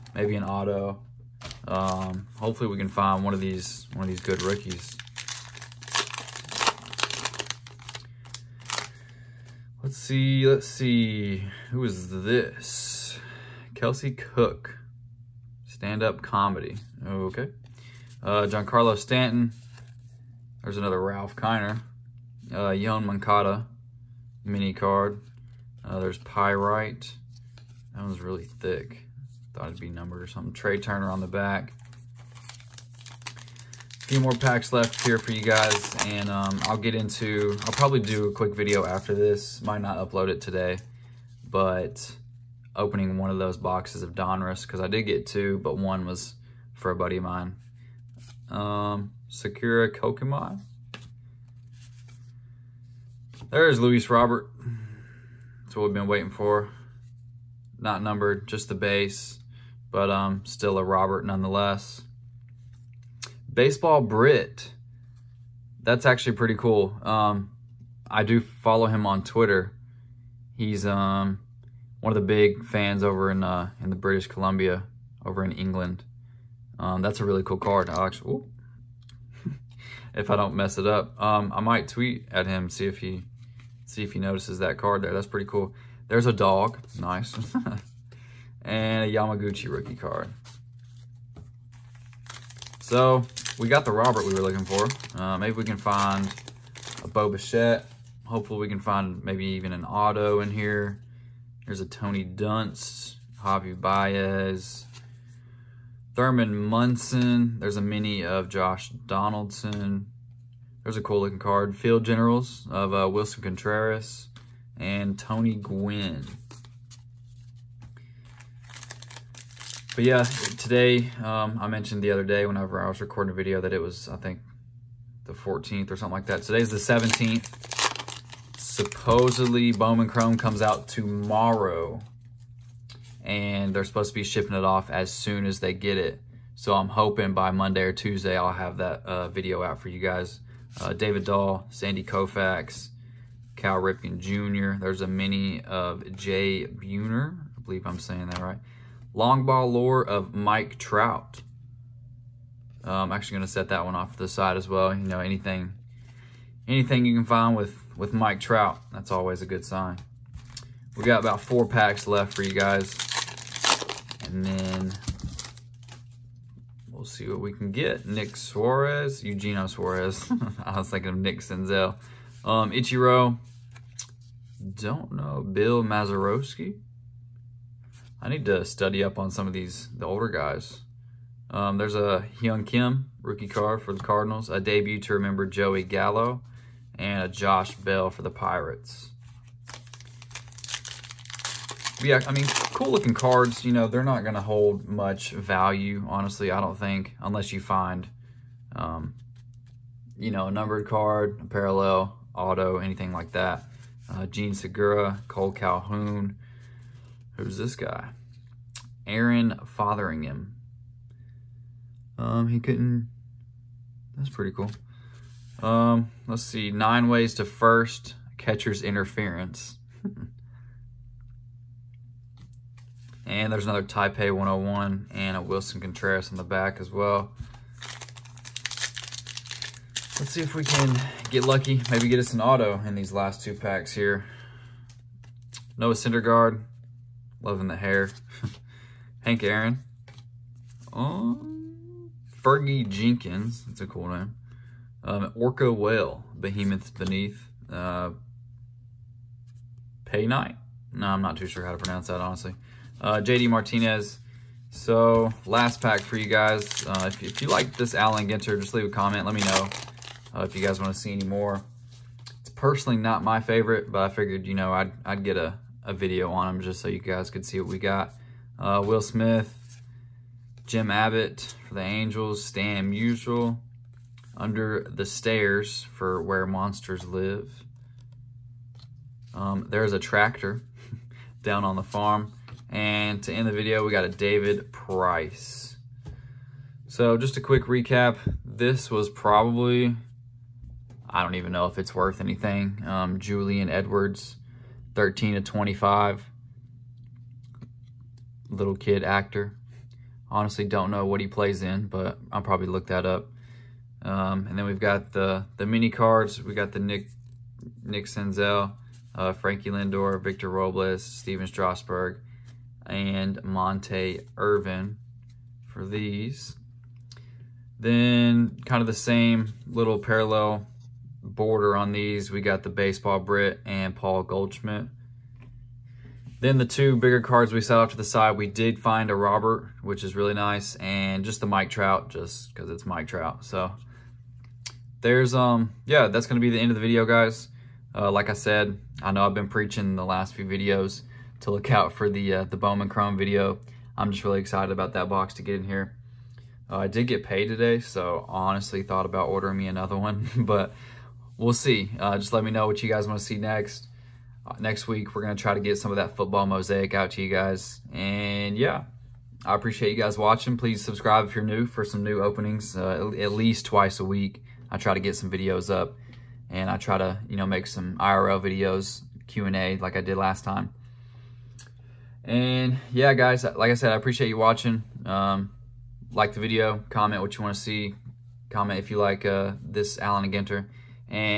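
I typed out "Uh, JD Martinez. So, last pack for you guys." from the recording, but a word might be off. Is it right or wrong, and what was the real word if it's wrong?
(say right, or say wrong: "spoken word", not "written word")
right.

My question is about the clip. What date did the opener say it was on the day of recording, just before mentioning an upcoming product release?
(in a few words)
17th.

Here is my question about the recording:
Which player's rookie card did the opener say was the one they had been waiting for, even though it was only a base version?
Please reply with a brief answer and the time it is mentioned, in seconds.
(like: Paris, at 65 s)
Luis Robert, at 53 s.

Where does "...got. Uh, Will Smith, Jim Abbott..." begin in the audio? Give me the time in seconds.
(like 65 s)
267 s.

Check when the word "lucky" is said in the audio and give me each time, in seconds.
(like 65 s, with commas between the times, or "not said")
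231 s.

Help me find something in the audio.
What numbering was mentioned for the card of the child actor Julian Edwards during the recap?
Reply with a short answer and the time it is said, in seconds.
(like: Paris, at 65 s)
13 to 25, at 294 s.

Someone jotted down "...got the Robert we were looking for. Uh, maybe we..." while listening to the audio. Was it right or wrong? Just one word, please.
right.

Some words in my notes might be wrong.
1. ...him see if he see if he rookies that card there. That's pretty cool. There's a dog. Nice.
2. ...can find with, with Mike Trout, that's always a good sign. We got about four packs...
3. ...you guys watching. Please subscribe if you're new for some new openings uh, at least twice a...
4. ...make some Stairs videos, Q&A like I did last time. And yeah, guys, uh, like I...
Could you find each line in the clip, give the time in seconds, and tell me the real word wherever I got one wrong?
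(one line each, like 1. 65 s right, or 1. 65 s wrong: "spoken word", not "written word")
1. 82 s wrong: "notices", not "rookies"
2. 157 s right
3. 359 s right
4. 367 s wrong: "IRL", not "Stairs".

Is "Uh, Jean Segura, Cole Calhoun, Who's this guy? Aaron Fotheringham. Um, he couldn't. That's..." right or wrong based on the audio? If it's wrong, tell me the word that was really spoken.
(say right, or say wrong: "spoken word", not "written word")
right.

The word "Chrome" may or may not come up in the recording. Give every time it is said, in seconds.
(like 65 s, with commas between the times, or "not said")
130 s, 342 s.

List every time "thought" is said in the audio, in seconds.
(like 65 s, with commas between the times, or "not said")
29 s, 348 s.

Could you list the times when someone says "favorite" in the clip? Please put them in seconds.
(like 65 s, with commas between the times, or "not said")
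263 s.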